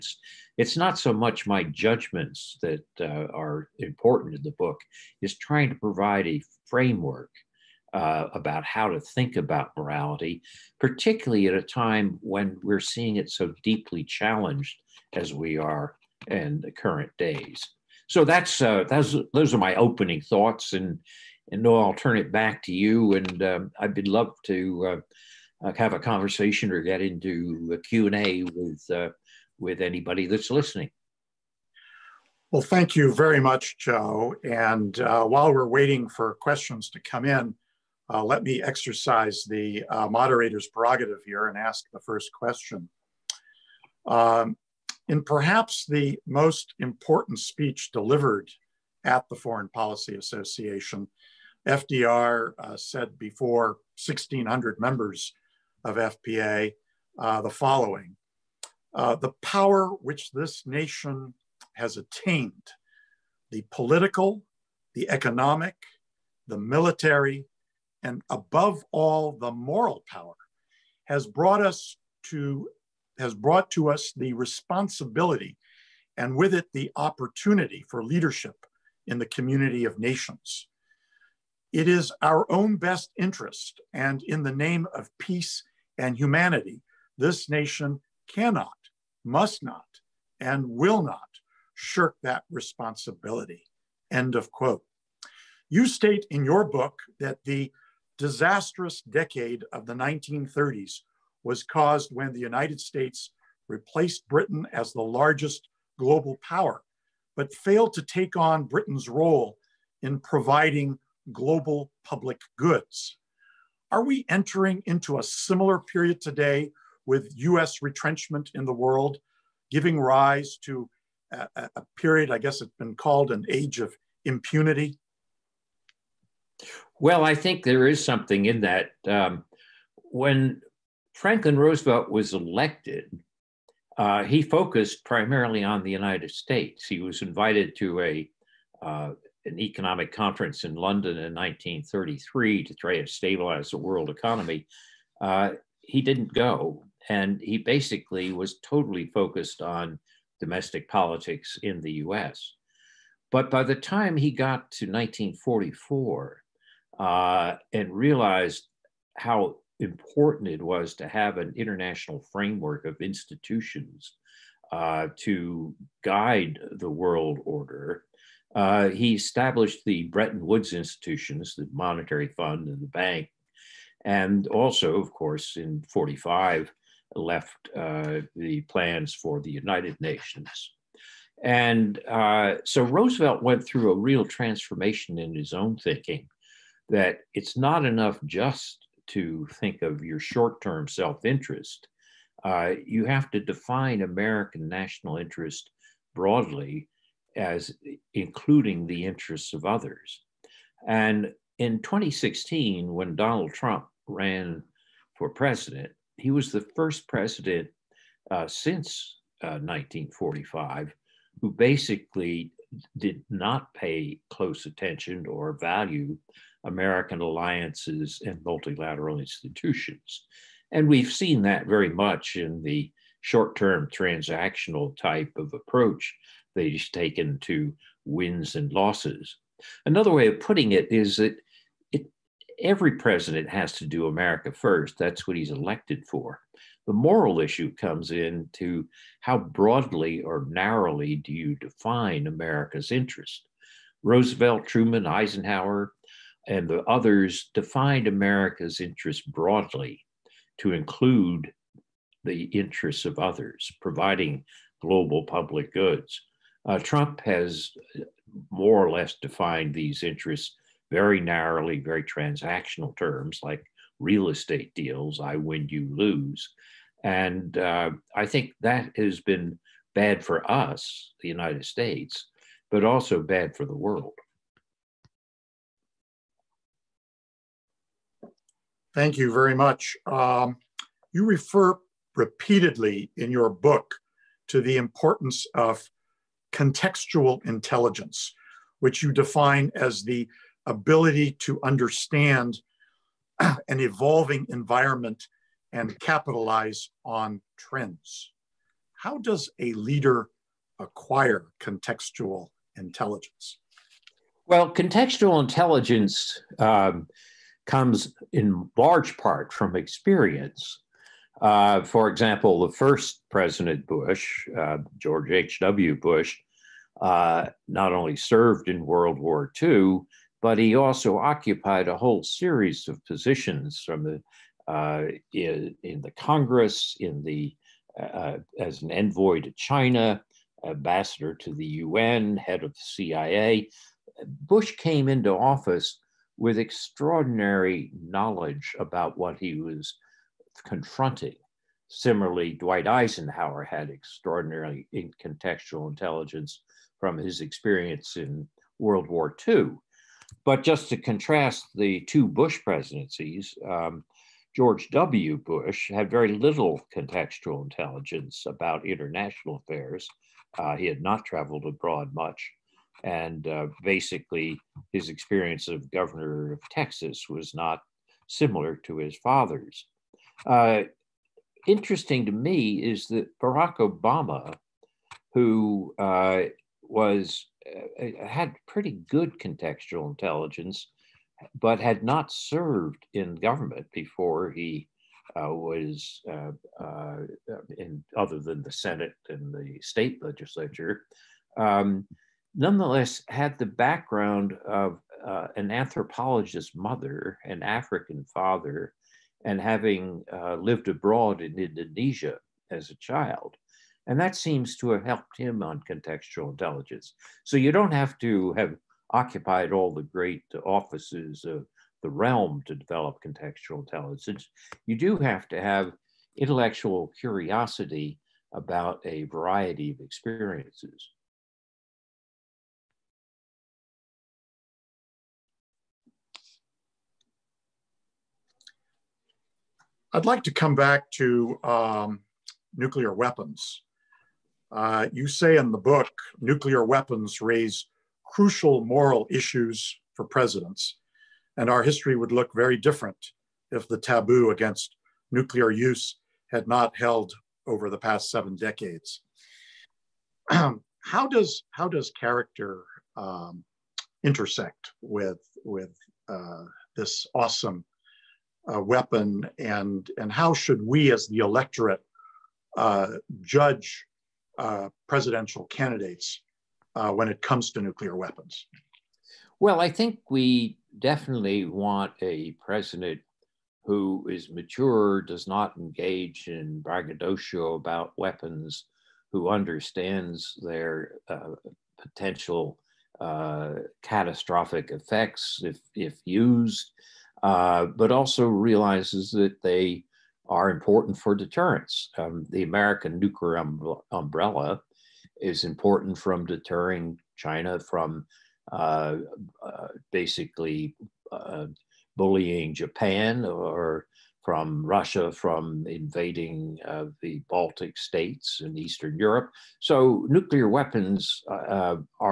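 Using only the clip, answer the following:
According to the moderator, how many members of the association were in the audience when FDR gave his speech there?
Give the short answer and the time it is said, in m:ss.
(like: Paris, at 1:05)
1,600, at 0:54.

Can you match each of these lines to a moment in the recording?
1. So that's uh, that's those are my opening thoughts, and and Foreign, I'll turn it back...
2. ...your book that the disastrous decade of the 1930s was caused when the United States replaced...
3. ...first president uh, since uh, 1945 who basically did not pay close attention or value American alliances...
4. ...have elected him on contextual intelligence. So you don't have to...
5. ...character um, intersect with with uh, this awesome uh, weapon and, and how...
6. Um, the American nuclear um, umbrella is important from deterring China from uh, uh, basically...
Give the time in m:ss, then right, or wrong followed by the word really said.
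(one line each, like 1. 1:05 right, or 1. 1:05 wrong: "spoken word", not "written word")
1. 0:18 wrong: "Noel", not "Foreign"
2. 1:36 right
3. 3:26 right
4. 6:44 wrong: "helped", not "elected"
5. 7:32 right
6. 8:12 right.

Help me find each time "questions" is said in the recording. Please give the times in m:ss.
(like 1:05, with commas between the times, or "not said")
0:36, 0:42.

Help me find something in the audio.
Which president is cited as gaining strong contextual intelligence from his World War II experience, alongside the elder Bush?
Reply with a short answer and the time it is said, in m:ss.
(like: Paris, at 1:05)
Dwight Eisenhower, at 5:42.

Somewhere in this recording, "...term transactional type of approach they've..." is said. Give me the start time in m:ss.
3:43.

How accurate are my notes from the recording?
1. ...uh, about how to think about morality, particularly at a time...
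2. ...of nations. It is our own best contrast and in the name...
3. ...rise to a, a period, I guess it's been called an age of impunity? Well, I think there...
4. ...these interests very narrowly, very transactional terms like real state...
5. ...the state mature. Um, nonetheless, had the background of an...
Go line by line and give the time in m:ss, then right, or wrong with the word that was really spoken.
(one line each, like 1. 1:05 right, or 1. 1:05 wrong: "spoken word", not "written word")
1. 0:07 right
2. 1:19 wrong: "interest", not "contrast"
3. 2:00 right
4. 4:19 wrong: "estate", not "state"
5. 6:29 wrong: "legislature", not "mature".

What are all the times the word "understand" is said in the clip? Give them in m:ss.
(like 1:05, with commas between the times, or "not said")
4:51, 7:59.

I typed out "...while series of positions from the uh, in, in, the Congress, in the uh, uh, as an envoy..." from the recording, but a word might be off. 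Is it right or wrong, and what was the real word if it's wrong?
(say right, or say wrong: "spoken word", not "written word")
wrong: "whole", not "while".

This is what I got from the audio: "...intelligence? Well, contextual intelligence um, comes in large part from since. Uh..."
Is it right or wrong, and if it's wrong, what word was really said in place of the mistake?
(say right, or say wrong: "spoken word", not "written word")
wrong: "experience", not "since".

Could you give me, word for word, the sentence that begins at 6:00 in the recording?
Uh, he had not traveled abroad much.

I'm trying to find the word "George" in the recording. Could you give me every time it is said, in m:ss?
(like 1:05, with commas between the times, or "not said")
5:14, 5:54.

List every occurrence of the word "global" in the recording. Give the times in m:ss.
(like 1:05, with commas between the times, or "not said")
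1:45, 1:51, 4:14.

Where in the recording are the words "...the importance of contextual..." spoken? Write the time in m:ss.
4:44.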